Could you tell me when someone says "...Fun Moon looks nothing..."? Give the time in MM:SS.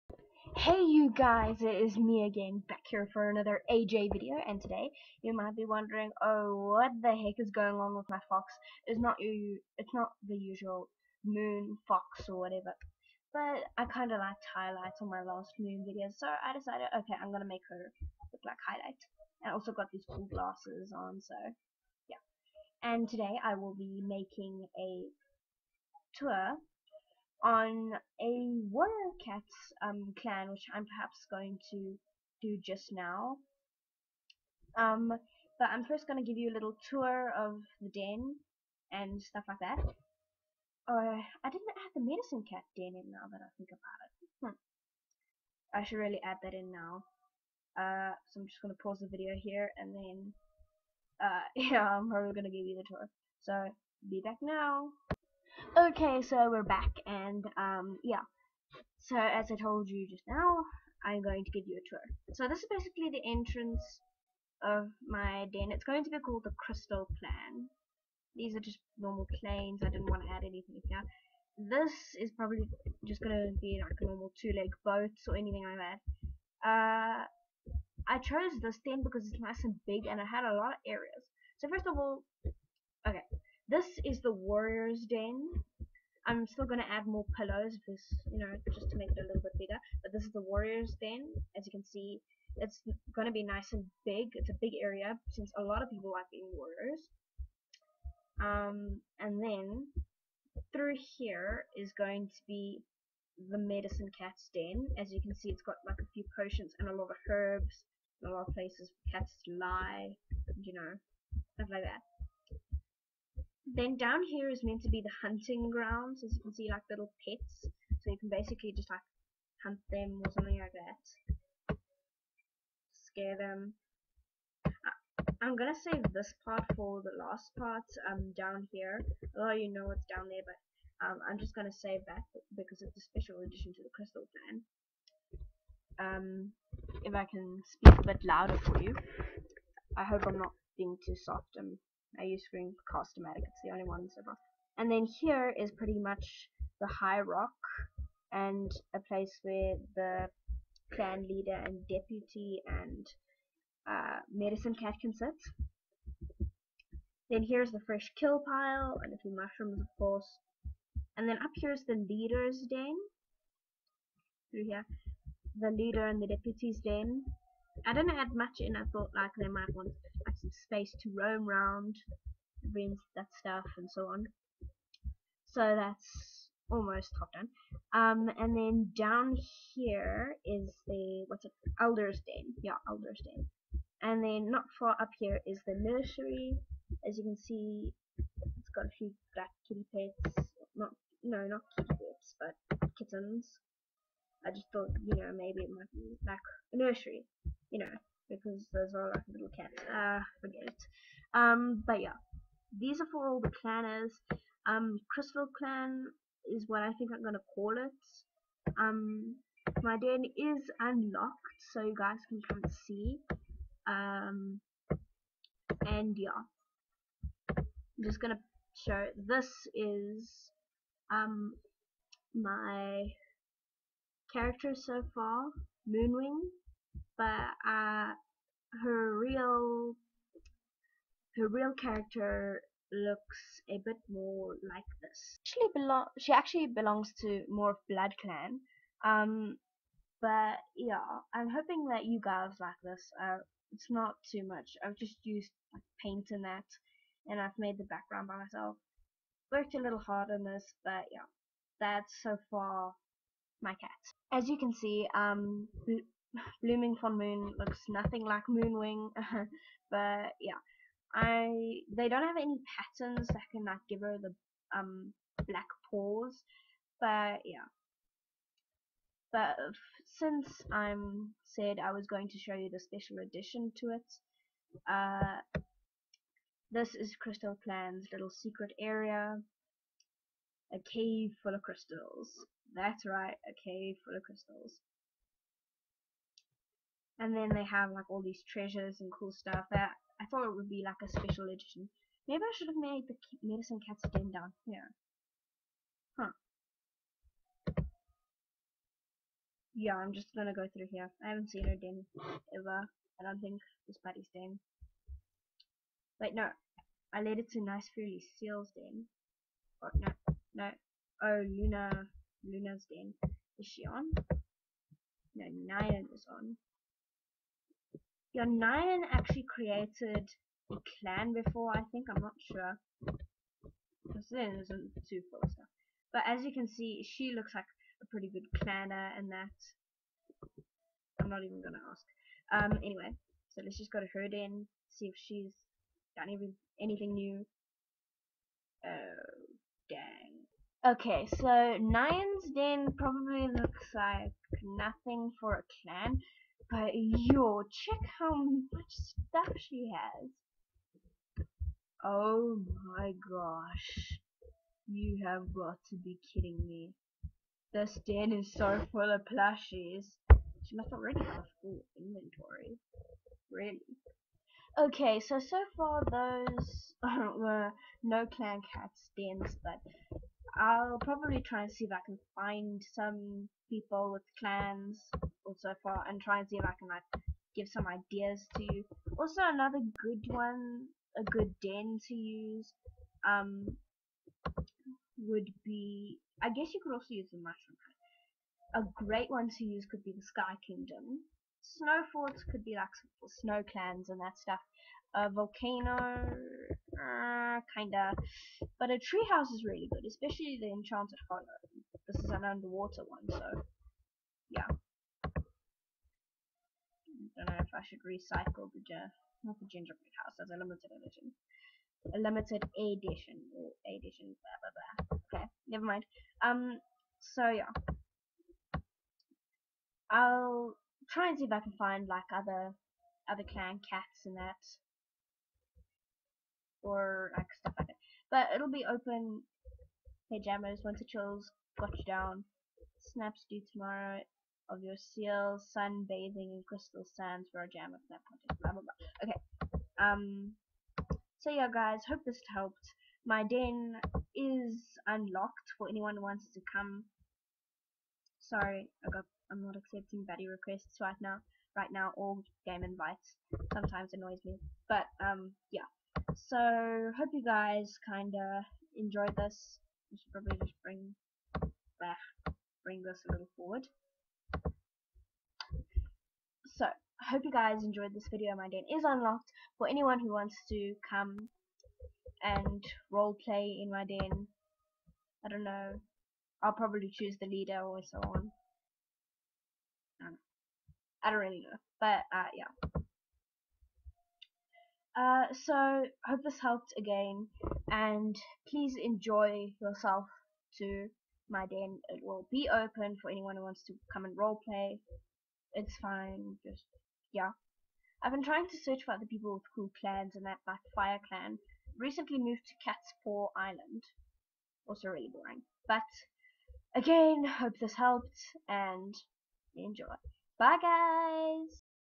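04:16.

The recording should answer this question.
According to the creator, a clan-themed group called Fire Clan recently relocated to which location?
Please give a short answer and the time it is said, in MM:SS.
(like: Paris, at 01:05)
Cat's Paw Island, at 08:22.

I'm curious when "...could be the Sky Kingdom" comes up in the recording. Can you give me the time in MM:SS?
06:29.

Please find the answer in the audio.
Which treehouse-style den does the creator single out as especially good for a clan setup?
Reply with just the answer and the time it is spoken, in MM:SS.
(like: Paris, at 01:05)
Enchanted Hollow, at 06:40.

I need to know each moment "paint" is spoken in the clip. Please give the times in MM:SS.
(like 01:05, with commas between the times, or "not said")
04:06.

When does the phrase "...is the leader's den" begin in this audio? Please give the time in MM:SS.
02:41.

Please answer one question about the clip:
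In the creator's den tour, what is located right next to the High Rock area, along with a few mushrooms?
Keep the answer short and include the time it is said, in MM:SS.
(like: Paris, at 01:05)
Fresh kill pile, at 02:37.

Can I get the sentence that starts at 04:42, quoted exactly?
That's right, a cave full of crystals.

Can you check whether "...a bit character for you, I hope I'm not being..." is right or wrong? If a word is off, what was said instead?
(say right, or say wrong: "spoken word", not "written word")
wrong: "louder", not "character".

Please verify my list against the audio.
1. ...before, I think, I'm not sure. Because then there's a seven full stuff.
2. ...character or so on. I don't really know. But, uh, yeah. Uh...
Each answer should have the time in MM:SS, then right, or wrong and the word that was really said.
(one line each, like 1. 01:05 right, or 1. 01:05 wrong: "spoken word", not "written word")
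1. 05:21 wrong: "two", not "seven"
2. 07:57 wrong: "leader", not "character".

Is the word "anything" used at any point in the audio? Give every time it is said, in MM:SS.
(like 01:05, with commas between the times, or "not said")
01:10, 01:15, 05:36.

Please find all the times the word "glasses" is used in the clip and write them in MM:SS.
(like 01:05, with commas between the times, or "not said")
00:20.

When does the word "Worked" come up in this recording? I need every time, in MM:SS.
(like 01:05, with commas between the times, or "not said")
04:09.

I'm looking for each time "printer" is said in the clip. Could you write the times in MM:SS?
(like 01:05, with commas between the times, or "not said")
not said.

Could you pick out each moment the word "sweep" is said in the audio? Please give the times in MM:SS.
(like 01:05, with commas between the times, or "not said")
not said.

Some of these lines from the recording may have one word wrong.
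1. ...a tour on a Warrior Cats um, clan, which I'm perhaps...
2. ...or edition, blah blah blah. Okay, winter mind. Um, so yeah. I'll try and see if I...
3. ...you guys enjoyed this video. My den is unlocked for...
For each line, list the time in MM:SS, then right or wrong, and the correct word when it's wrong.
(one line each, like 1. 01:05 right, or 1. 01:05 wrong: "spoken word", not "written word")
1. 00:24 right
2. 06:53 wrong: "never", not "winter"
3. 07:47 right.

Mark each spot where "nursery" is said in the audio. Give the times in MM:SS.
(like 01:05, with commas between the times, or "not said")
03:05, 03:16.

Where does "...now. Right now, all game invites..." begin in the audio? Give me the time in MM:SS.
07:31.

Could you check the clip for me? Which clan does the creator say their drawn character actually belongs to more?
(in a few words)
Blood Clan.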